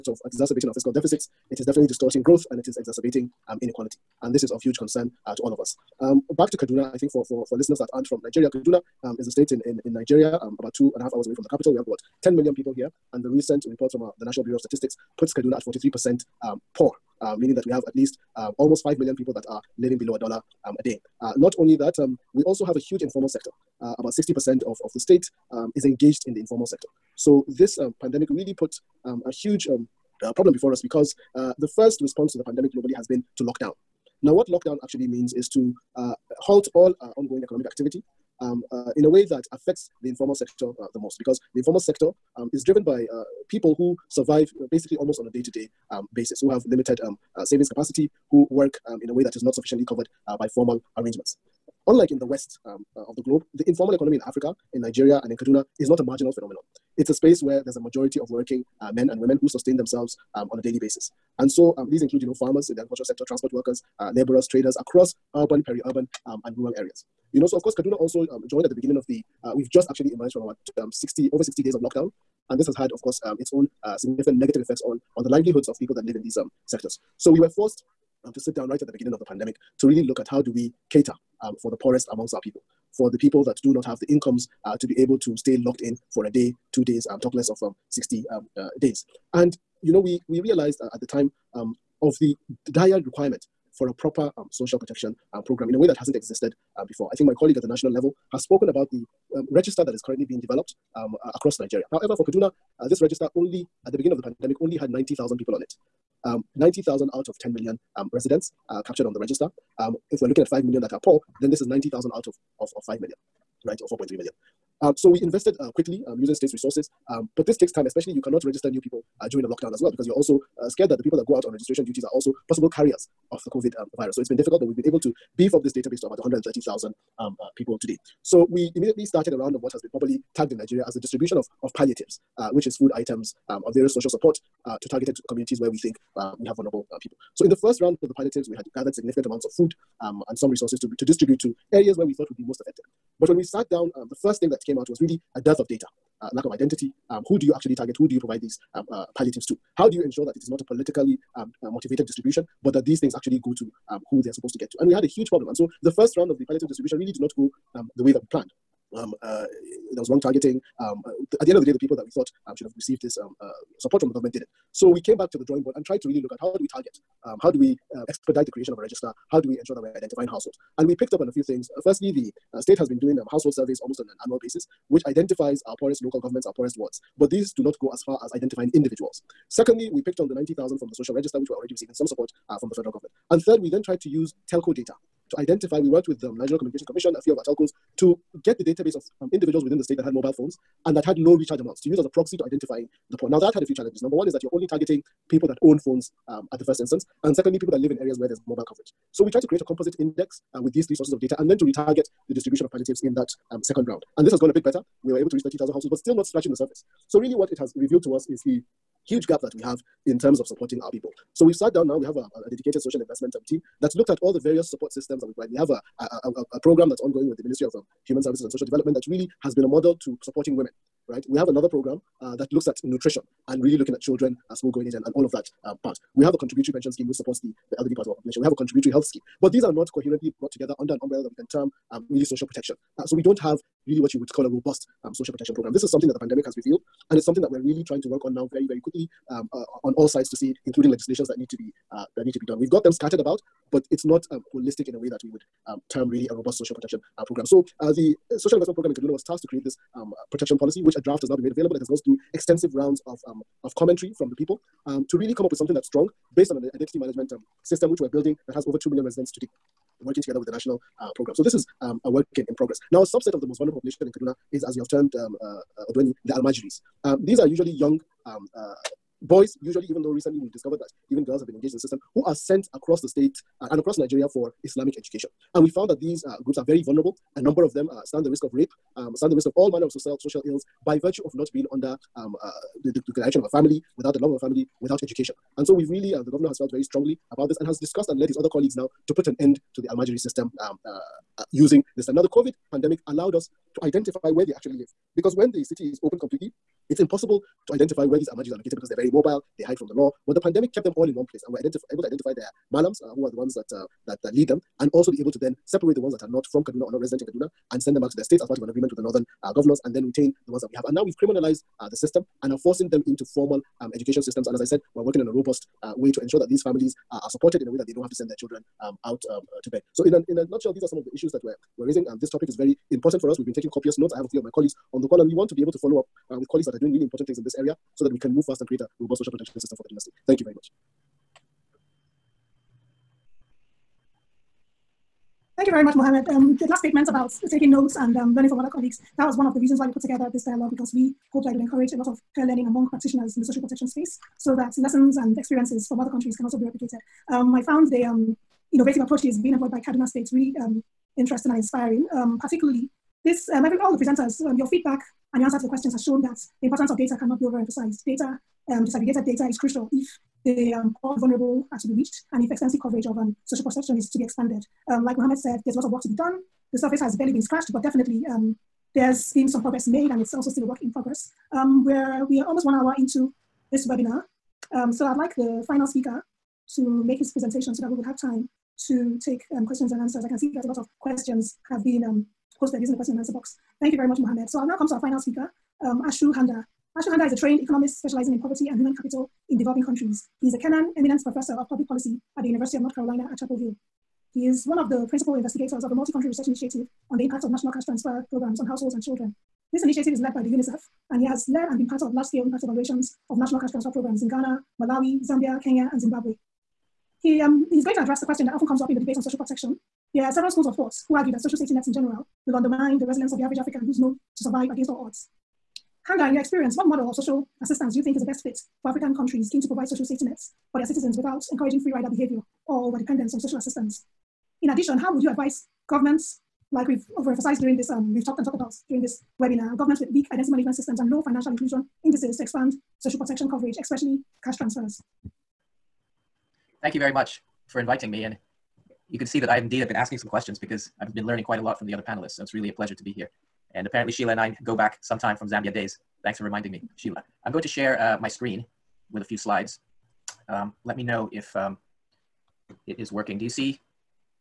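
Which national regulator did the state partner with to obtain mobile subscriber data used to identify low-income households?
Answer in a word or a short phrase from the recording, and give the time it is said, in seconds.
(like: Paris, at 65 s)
National Communications Commission, at 186 s.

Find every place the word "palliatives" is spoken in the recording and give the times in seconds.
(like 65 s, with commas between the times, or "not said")
131 s, 138 s, 149 s, 156 s, 202 s.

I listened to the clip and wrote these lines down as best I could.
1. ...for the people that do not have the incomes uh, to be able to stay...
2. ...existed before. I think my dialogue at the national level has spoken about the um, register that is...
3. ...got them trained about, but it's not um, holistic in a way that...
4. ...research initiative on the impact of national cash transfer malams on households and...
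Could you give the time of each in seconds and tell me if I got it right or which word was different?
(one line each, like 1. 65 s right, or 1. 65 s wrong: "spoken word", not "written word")
1. 82 s right
2. 96 s wrong: "colleague", not "dialogue"
3. 242 s wrong: "scattered", not "trained"
4. 396 s wrong: "programs", not "malams".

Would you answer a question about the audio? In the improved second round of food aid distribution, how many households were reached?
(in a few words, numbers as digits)
30,000.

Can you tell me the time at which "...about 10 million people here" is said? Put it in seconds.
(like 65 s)
11 s.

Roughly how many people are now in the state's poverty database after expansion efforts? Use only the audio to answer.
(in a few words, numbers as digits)
130,000.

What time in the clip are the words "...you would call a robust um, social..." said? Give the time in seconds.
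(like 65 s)
234 s.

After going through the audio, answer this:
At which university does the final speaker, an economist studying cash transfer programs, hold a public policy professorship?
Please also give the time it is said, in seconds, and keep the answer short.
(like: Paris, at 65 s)
University of North Carolina at Chapel Hill, at 392 s.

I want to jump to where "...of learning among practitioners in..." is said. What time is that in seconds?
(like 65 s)
342 s.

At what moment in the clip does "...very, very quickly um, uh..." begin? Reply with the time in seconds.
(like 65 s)
238 s.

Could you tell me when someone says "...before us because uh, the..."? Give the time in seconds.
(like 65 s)
30 s.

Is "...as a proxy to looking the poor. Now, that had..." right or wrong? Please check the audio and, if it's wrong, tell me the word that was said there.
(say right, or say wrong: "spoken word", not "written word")
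wrong: "identifying", not "looking".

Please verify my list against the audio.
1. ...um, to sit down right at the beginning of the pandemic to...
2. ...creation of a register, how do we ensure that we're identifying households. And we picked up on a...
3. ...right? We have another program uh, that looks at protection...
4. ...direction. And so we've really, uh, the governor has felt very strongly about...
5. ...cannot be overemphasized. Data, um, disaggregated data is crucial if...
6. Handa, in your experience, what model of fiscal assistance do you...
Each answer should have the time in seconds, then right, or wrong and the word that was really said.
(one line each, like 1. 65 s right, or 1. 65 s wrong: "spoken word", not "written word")
1. 78 s right
2. 168 s right
3. 221 s wrong: "nutrition", not "protection"
4. 285 s wrong: "education", not "direction"
5. 357 s right
6. 416 s wrong: "social", not "fiscal".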